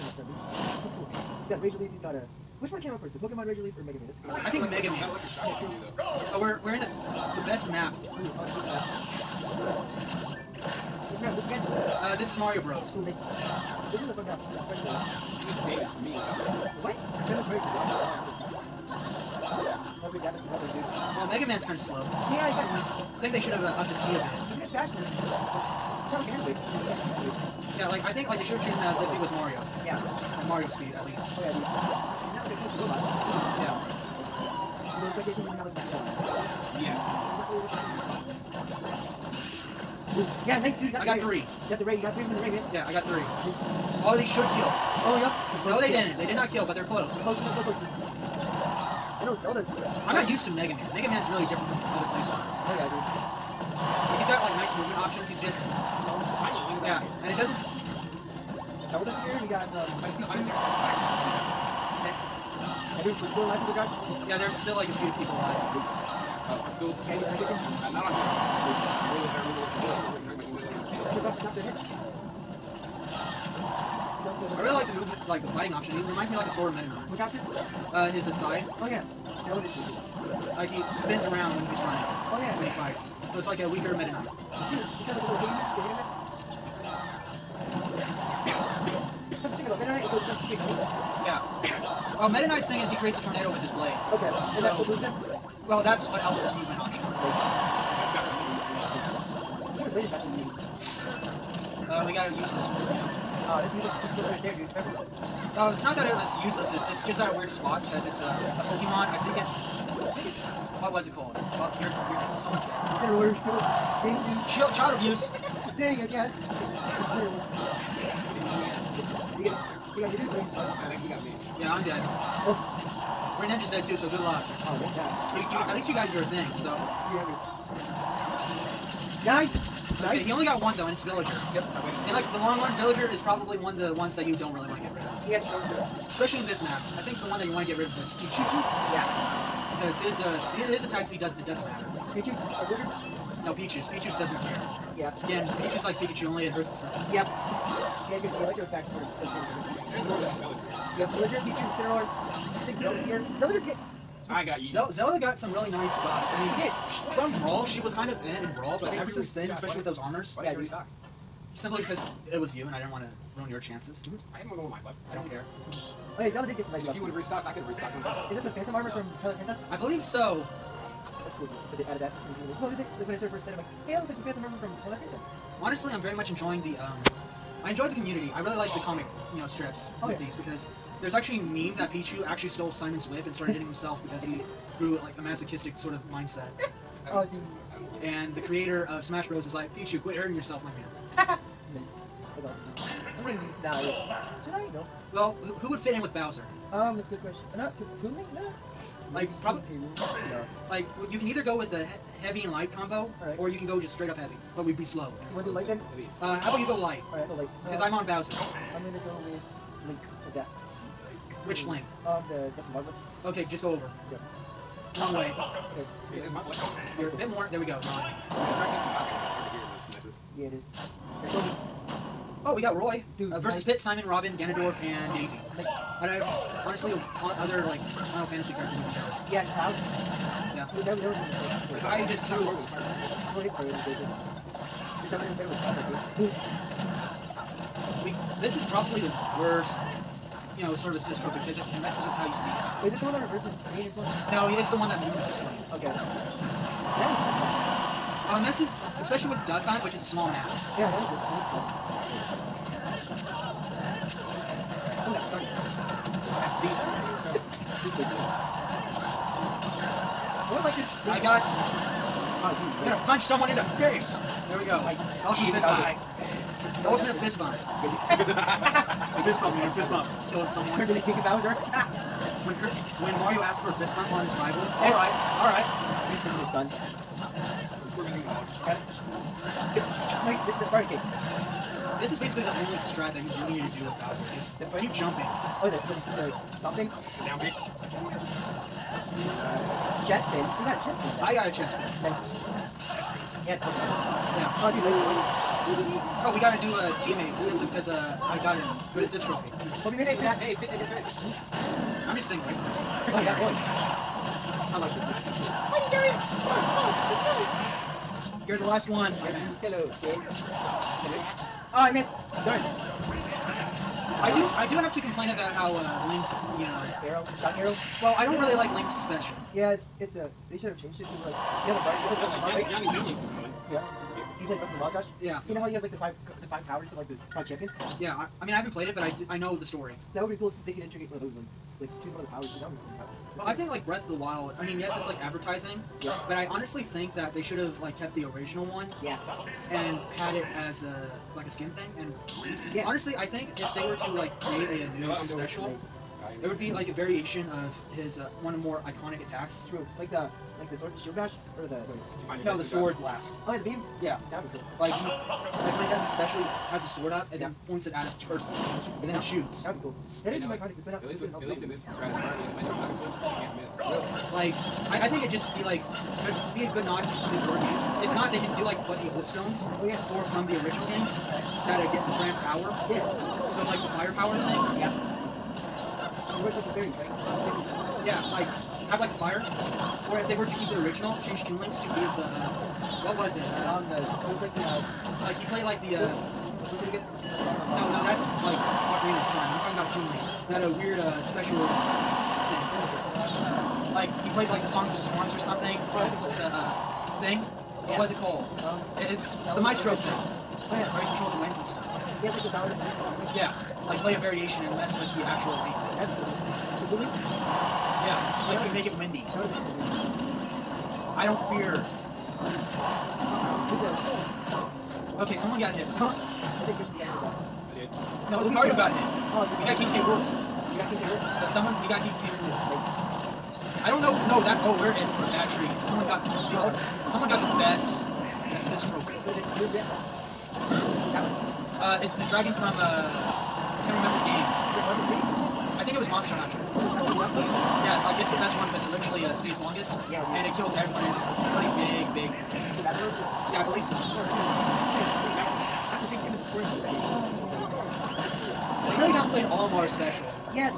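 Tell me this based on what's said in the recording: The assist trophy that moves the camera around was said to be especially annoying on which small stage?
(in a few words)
Duck Hunt.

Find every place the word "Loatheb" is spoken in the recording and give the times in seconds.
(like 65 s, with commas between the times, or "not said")
not said.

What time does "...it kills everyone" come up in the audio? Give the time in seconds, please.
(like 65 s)
440 s.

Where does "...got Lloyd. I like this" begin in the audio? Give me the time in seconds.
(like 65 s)
303 s.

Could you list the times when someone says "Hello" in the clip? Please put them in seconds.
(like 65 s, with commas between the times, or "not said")
309 s.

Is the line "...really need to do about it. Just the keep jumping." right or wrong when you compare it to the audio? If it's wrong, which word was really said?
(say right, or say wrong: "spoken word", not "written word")
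right.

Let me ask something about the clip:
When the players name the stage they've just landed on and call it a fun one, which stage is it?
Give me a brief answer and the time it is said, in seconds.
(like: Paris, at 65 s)
Mario Bros., at 12 s.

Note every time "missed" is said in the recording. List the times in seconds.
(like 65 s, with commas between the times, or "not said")
299 s, 311 s.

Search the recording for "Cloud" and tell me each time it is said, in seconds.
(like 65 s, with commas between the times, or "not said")
229 s.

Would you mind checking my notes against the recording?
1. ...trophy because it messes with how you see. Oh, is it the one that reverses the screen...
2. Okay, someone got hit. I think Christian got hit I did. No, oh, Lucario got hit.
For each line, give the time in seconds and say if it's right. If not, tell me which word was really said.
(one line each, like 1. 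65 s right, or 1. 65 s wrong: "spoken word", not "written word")
1. 241 s right
2. 415 s right.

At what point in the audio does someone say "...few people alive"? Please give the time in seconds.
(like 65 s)
64 s.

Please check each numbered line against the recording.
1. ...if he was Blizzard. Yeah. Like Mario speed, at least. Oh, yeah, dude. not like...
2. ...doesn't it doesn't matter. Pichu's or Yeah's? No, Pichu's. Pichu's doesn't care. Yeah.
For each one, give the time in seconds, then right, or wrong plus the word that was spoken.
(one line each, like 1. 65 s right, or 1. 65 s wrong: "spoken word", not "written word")
1. 28 s wrong: "Mario", not "Blizzard"
2. 141 s wrong: "Blueber", not "Yeah".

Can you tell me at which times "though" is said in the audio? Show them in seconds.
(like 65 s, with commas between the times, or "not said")
130 s.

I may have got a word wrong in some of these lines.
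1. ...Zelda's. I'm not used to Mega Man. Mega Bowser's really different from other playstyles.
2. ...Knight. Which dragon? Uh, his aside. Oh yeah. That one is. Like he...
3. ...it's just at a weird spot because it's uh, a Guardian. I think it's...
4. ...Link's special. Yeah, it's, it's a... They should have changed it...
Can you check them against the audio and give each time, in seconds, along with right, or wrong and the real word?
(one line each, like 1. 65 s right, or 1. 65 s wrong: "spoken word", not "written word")
1. 49 s wrong: "Man", not "Bowser"
2. 76 s wrong: "option", not "dragon"
3. 106 s wrong: "Pokemon", not "Guardian"
4. 318 s right.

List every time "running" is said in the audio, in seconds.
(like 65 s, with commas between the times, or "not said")
81 s.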